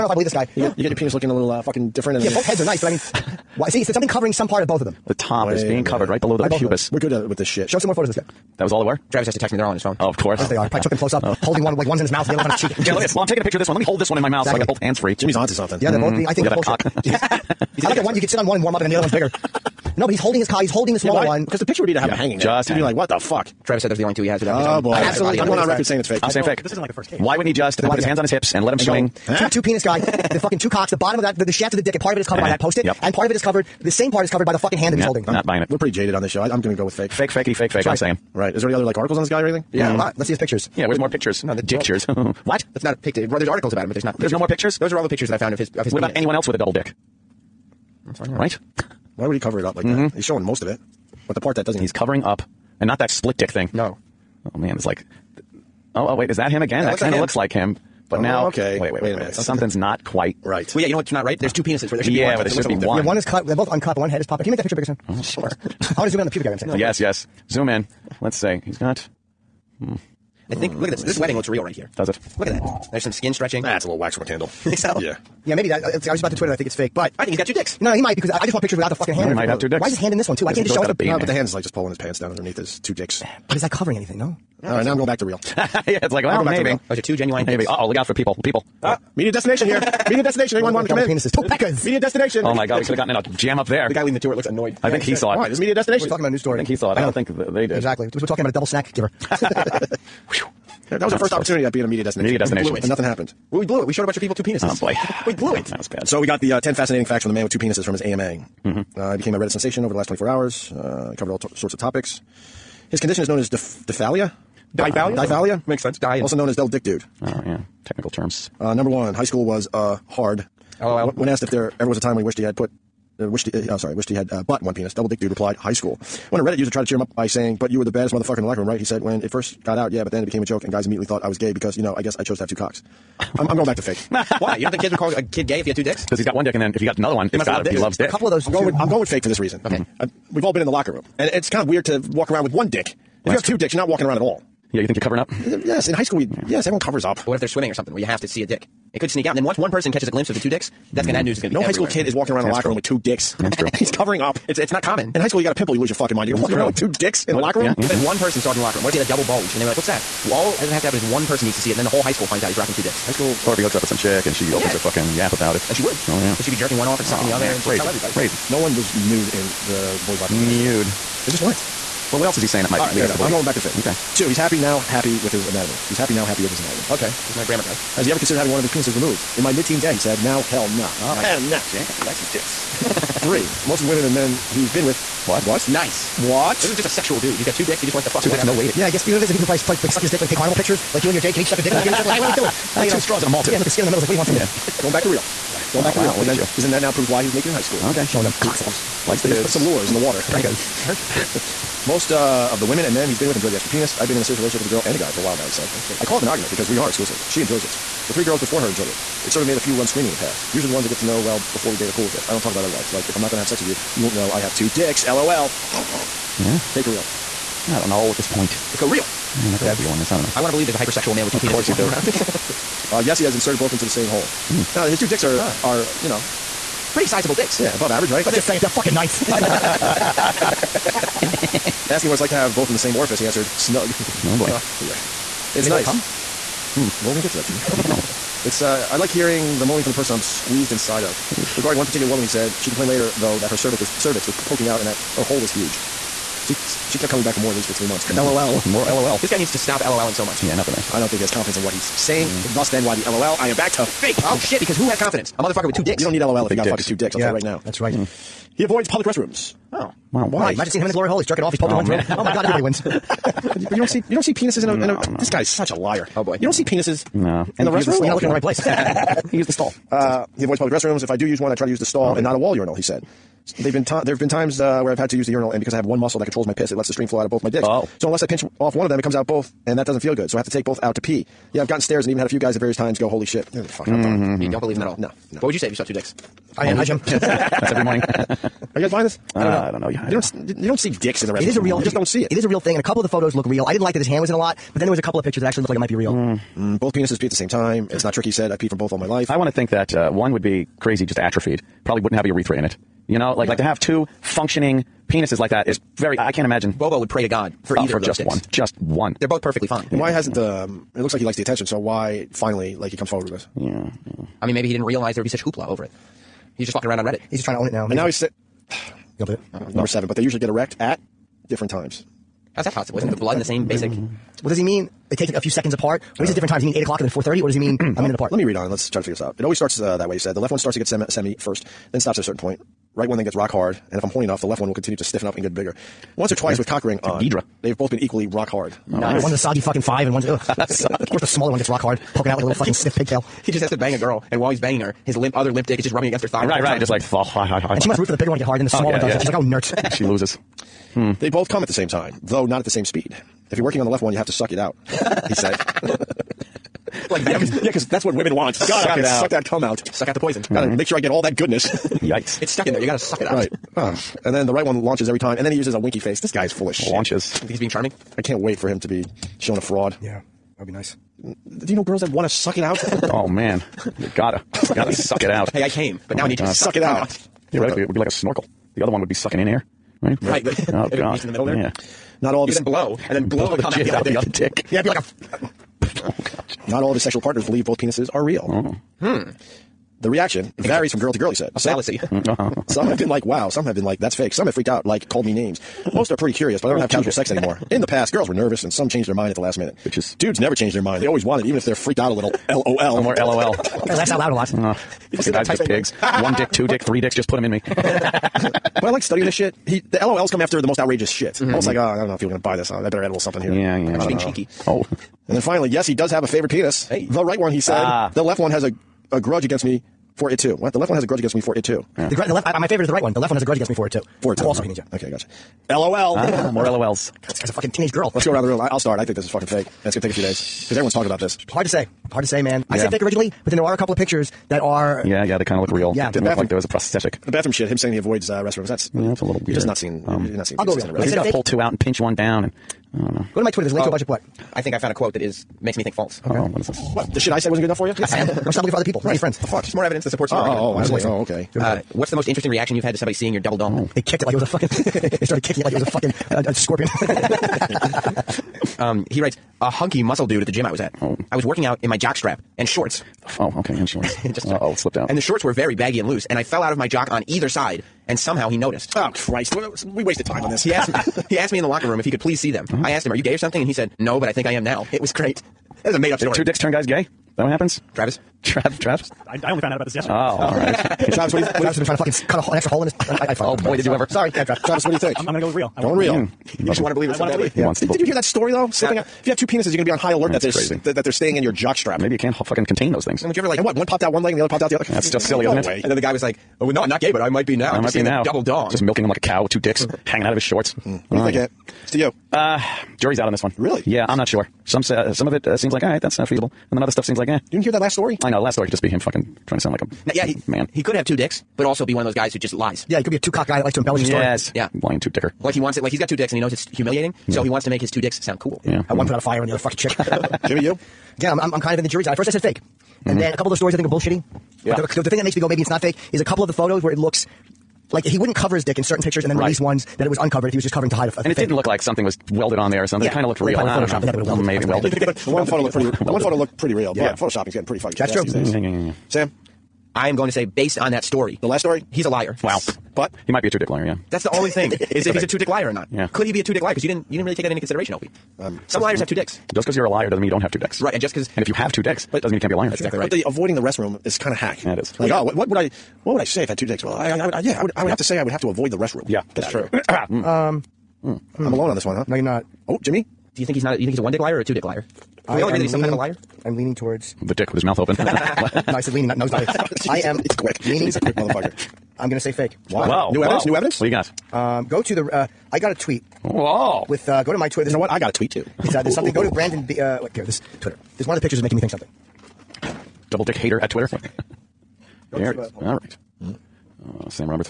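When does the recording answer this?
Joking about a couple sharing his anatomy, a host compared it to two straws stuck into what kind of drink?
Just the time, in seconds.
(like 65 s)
193 s.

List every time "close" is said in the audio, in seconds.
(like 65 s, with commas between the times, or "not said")
10 s, 101 s.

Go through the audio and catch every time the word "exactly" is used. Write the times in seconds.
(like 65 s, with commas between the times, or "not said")
14 s, 97 s, 552 s.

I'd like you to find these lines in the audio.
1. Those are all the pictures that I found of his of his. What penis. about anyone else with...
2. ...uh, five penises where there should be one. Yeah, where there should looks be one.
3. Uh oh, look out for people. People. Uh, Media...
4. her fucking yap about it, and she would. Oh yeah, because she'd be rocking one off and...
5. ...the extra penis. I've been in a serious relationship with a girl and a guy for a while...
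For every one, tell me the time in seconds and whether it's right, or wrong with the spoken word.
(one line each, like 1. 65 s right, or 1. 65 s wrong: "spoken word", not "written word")
1. 44 s right
2. 61 s wrong: "two", not "five"
3. 87 s right
4. 164 s wrong: "jerking", not "rocking"
5. 203 s right.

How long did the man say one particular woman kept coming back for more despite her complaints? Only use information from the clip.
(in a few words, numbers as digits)
Three months.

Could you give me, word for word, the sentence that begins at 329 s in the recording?
It always starts uh, that way.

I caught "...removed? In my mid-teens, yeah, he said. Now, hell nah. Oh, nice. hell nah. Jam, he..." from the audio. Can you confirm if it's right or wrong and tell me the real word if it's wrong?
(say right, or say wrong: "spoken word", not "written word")
right.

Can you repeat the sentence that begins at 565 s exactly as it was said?
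Can I we all agree that he's some leaning, kind of a liar?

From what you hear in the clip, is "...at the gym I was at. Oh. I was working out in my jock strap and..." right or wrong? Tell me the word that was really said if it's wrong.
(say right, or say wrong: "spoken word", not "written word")
right.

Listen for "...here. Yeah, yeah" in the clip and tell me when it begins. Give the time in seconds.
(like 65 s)
413 s.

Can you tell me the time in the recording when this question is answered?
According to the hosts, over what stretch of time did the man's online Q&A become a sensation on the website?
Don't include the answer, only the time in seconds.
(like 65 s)
110 s.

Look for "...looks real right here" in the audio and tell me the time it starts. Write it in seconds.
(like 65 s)
71 s.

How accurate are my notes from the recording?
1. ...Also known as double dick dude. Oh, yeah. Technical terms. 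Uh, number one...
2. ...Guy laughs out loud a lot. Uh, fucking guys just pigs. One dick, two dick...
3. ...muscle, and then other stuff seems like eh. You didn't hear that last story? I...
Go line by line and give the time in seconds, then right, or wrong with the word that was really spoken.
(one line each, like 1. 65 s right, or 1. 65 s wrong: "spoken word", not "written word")
1. 116 s right
2. 403 s right
3. 506 s wrong: "feasible", not "muscle".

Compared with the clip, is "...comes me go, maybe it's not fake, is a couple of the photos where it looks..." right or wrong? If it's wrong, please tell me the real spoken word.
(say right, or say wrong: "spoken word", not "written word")
wrong: "makes", not "comes".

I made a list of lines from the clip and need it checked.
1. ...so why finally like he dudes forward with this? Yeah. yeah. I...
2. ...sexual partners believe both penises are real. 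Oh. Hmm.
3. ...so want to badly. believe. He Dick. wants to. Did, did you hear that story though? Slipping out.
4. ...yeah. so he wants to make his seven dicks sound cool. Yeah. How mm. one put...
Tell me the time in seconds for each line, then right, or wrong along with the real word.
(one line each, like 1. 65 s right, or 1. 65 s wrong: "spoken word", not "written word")
1. 311 s wrong: "comes", not "dudes"
2. 387 s right
3. 487 s wrong: "Yeah", not "Dick"
4. 517 s wrong: "two", not "seven".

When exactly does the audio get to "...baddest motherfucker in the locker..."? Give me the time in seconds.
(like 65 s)
127 s.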